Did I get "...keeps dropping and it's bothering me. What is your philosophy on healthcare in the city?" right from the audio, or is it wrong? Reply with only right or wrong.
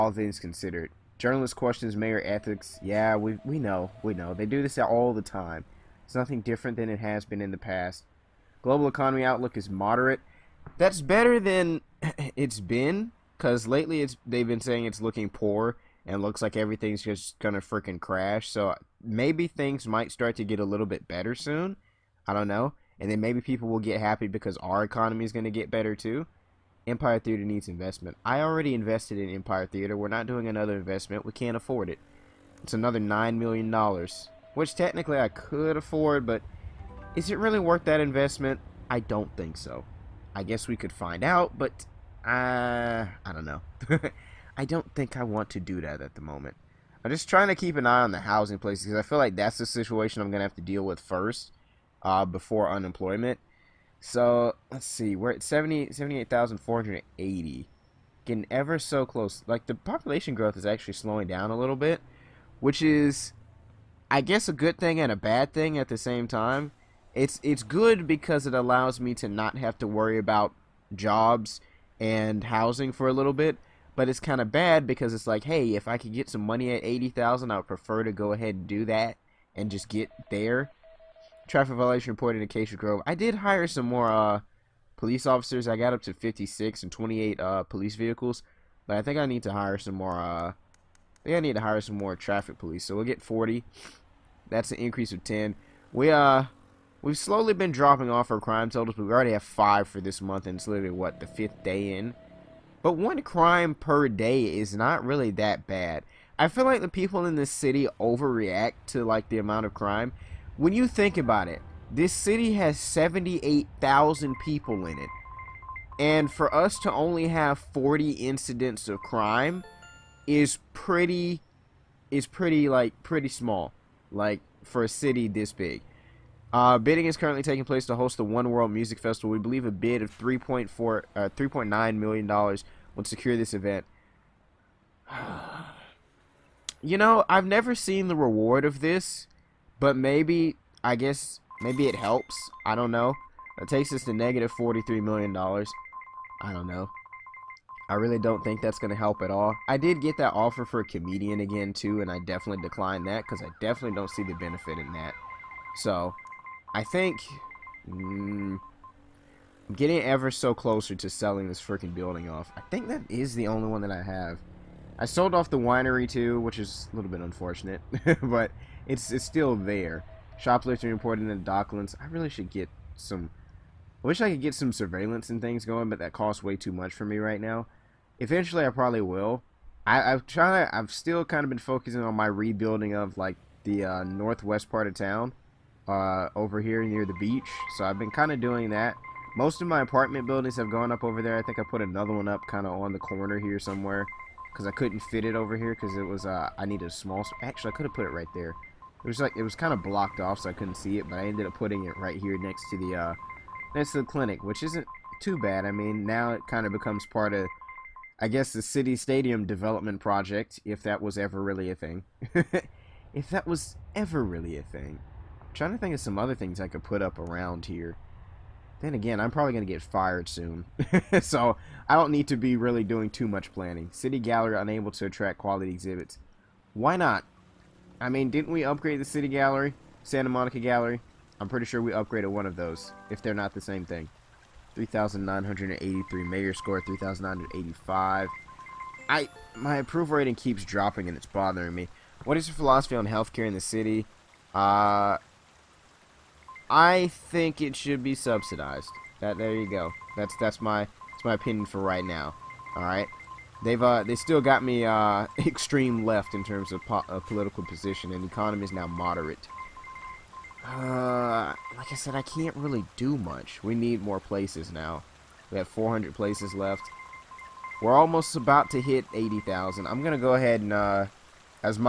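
right.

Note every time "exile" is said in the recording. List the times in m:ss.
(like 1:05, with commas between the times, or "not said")
not said.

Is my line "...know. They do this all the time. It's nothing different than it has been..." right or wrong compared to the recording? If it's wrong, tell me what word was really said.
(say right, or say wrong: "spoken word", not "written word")
right.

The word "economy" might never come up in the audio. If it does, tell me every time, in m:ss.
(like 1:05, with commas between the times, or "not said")
0:08, 0:24, 4:18.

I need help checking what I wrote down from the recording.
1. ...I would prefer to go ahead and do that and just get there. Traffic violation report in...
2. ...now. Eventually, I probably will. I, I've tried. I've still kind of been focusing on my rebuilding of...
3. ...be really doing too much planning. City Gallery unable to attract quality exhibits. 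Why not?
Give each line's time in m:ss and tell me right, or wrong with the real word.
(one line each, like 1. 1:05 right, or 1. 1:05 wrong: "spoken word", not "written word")
1. 1:17 right
2. 2:57 right
3. 3:42 right.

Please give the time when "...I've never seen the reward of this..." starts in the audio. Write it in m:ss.
2:17.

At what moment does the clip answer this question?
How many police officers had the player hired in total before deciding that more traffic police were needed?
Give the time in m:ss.
1:26.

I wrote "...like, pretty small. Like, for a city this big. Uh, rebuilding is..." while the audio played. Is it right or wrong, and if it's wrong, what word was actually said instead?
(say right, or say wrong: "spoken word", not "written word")
wrong: "bidding", not "rebuilding".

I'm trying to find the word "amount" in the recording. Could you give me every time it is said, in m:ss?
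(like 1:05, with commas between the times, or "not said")
1:49.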